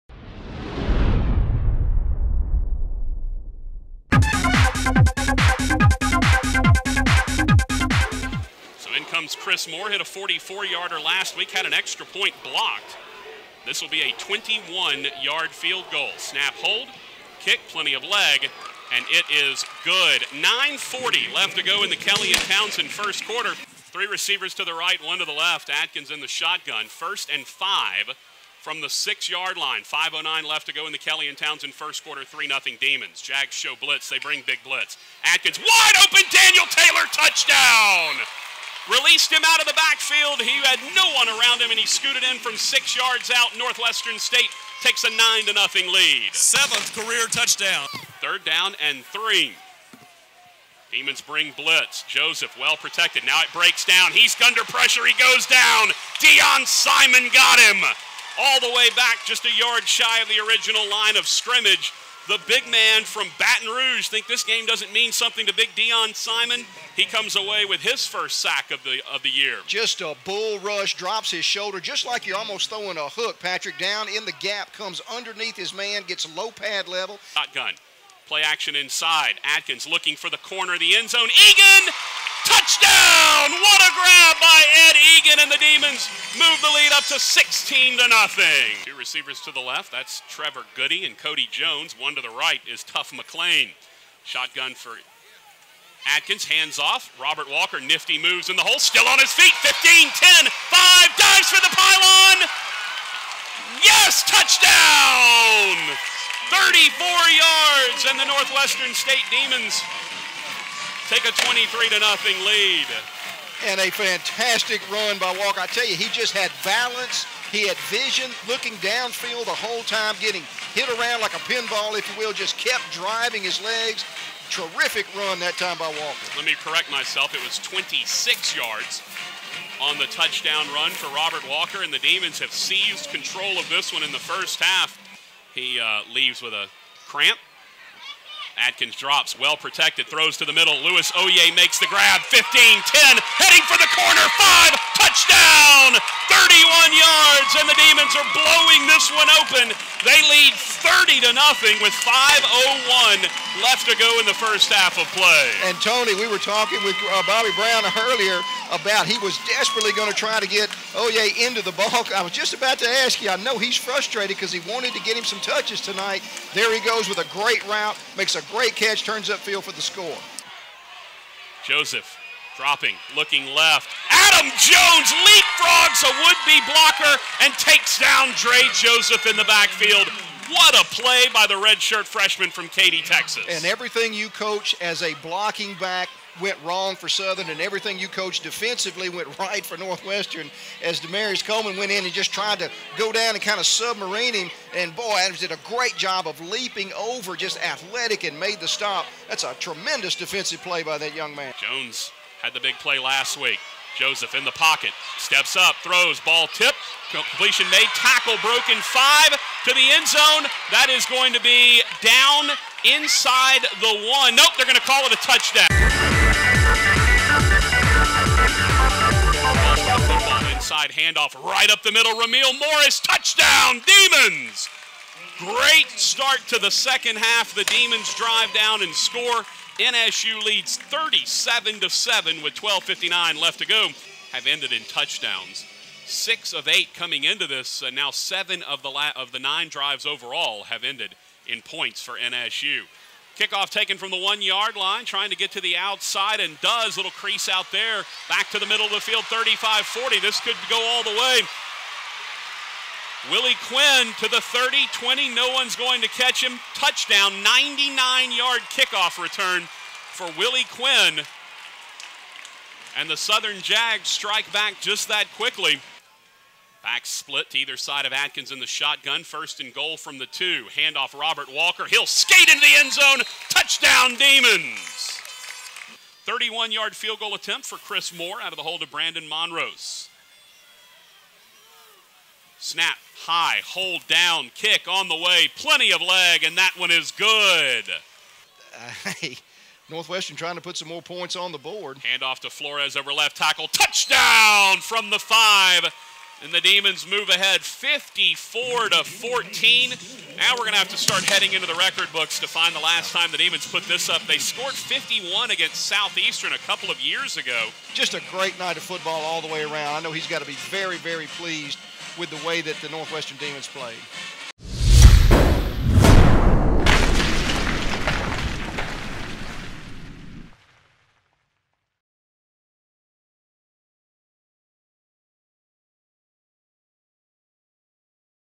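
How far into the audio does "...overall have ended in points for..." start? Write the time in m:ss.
4:00.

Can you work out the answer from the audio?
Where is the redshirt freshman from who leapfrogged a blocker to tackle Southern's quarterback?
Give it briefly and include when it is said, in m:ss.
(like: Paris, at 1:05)
Katy, Texas, at 3:02.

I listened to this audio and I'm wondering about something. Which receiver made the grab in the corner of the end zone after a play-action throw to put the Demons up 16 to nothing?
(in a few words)
Ed Egan.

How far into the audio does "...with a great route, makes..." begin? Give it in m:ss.
2:47.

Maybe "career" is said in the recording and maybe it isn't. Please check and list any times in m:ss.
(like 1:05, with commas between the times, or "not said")
0:46.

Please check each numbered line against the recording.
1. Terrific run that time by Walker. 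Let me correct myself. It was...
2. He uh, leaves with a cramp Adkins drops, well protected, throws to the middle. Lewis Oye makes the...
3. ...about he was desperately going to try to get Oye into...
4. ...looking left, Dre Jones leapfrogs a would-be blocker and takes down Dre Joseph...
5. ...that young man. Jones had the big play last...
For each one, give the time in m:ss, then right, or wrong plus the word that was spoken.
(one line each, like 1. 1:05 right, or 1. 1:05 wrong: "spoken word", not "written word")
1. 2:04 right
2. 2:15 right
3. 2:38 right
4. 2:53 wrong: "Adam", not "Dre"
5. 3:20 right.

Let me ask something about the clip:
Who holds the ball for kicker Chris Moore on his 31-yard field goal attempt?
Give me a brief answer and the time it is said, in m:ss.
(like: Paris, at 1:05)
Brandon Monrose, at 4:38.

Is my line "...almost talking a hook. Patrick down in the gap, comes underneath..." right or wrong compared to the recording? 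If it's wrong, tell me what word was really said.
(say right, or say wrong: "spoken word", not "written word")
wrong: "throwing", not "talking".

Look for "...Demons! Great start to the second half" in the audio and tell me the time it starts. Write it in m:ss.
3:43.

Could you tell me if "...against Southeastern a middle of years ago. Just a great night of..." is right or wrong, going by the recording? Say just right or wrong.
wrong.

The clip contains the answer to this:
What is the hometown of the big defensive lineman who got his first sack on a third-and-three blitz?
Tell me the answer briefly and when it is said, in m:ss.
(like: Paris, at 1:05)
Baton Rouge, at 1:03.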